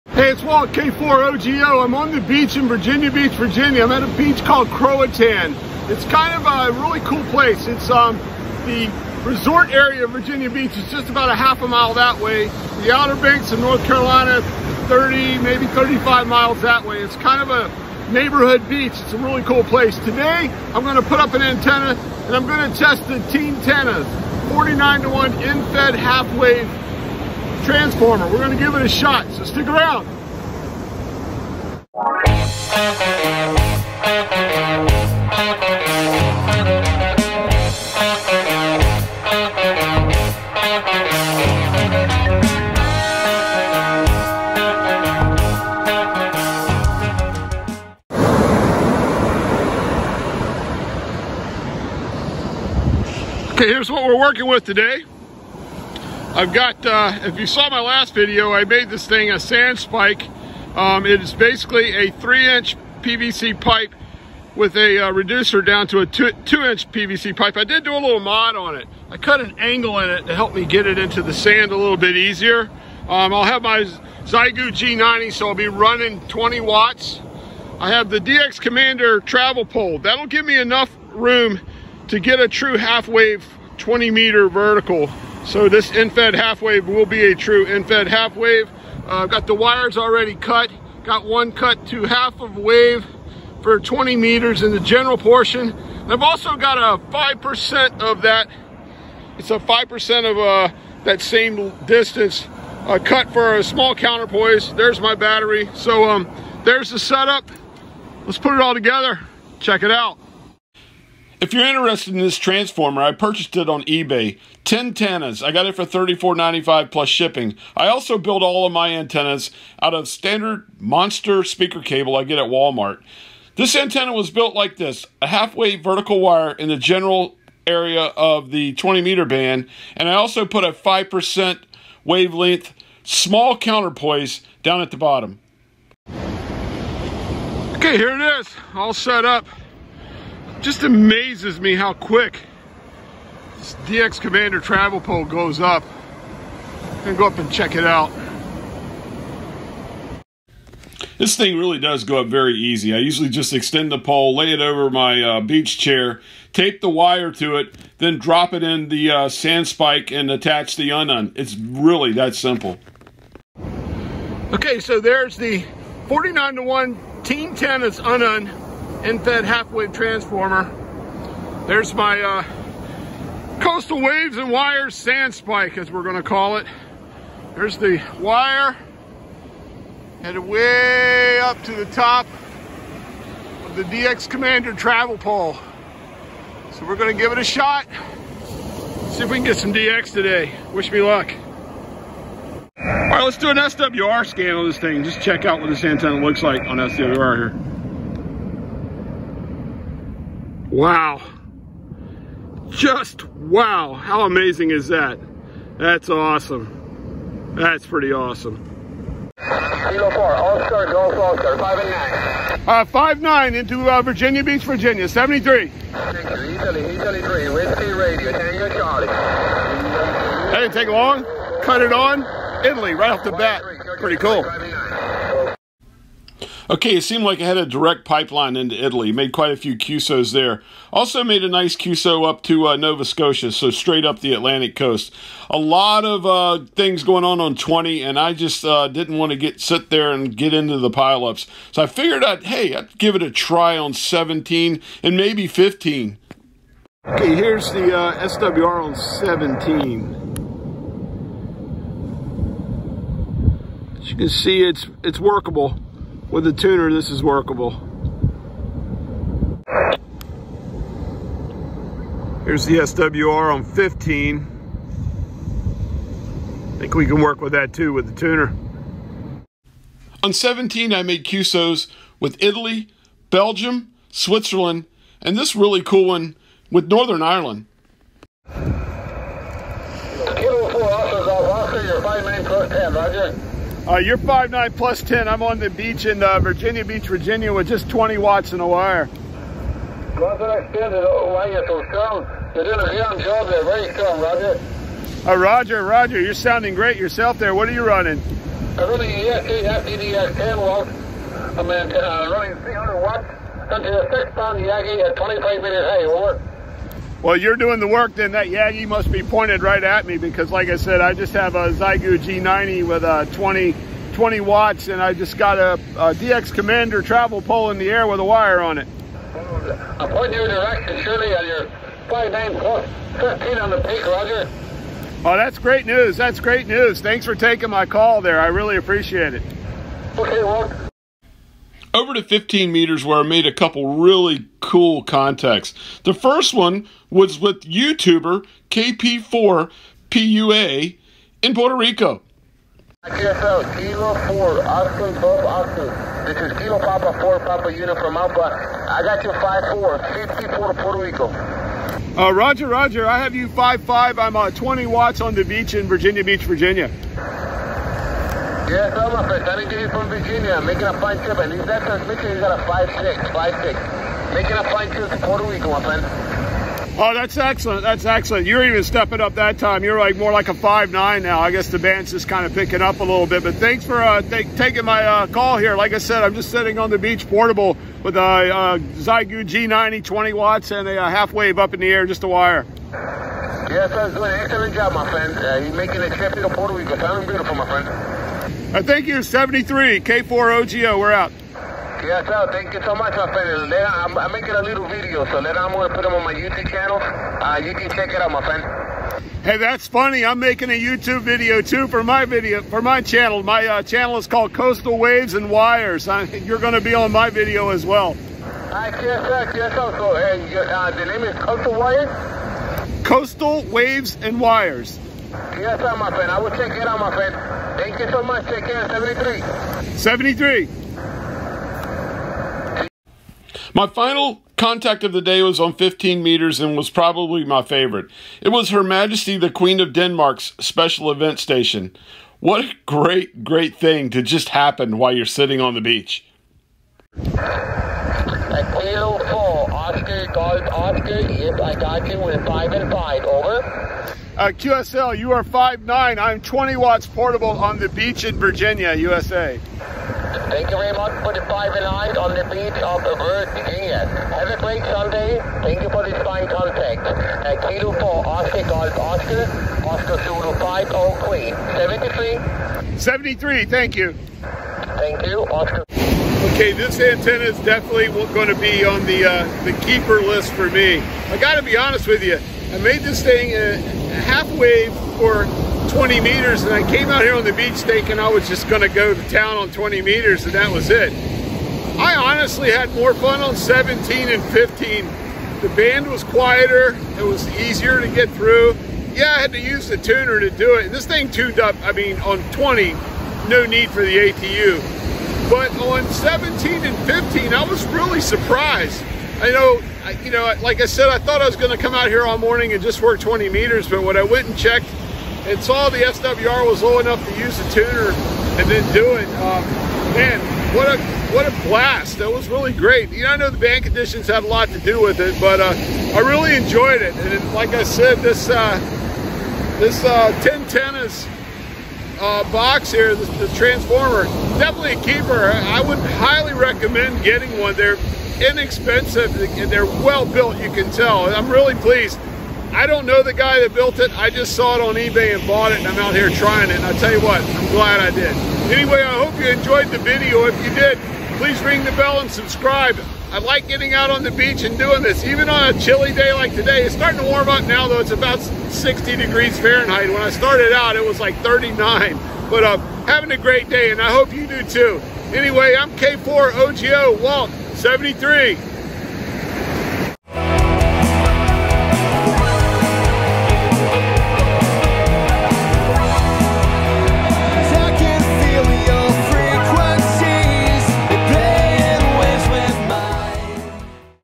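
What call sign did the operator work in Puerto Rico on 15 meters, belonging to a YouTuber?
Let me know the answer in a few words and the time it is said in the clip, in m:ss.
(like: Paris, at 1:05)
KP4PUA, at 5:38.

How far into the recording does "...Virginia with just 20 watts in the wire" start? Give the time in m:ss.
4:47.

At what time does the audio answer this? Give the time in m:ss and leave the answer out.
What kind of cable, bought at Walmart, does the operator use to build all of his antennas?
2:00.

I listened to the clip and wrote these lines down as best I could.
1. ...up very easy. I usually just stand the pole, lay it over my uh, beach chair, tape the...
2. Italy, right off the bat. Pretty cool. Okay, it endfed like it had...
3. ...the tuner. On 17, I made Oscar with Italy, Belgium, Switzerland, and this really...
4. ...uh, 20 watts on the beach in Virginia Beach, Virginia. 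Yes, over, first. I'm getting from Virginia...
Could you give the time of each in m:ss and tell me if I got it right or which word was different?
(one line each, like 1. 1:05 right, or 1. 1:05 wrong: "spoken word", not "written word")
1. 2:32 wrong: "extend", not "stand"
2. 3:42 wrong: "seemed", not "endfed"
3. 4:28 wrong: "QSOs", not "Oscar"
4. 5:54 right.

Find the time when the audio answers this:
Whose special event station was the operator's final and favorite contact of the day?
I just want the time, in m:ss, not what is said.
7:08.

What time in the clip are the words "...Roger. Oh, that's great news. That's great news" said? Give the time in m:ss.
5:24.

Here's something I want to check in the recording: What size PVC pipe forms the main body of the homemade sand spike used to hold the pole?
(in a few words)
3 inch.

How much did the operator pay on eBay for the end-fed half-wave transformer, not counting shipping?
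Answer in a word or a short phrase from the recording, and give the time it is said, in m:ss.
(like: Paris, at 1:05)
$34.95, at 1:55.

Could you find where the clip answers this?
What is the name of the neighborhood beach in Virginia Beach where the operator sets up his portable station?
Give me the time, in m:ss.
0:04.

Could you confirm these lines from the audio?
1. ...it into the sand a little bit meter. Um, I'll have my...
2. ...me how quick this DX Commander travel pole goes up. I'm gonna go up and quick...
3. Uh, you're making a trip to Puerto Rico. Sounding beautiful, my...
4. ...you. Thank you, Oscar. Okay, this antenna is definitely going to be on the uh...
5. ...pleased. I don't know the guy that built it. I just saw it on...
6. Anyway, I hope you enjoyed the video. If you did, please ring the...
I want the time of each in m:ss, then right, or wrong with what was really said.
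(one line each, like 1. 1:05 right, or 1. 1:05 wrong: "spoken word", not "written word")
1. 1:10 wrong: "easier", not "meter"
2. 2:21 wrong: "check", not "quick"
3. 6:25 right
4. 7:43 right
5. 8:51 right
6. 8:58 right.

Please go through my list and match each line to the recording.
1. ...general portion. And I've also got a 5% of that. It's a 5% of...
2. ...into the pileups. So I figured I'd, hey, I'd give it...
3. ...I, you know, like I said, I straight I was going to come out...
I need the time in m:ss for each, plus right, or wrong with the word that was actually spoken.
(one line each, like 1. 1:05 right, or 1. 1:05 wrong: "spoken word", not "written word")
1. 1:34 right
2. 4:00 right
3. 8:20 wrong: "thought", not "straight".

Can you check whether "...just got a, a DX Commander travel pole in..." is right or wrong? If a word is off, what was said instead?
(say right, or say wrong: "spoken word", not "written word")
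right.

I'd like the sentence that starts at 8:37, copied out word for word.
And like I said, this uh, this uh, TennTennas uh, box here, the, the transformer.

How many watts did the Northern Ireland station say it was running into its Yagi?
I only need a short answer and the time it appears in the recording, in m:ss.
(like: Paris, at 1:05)
300 watts, at 5:02.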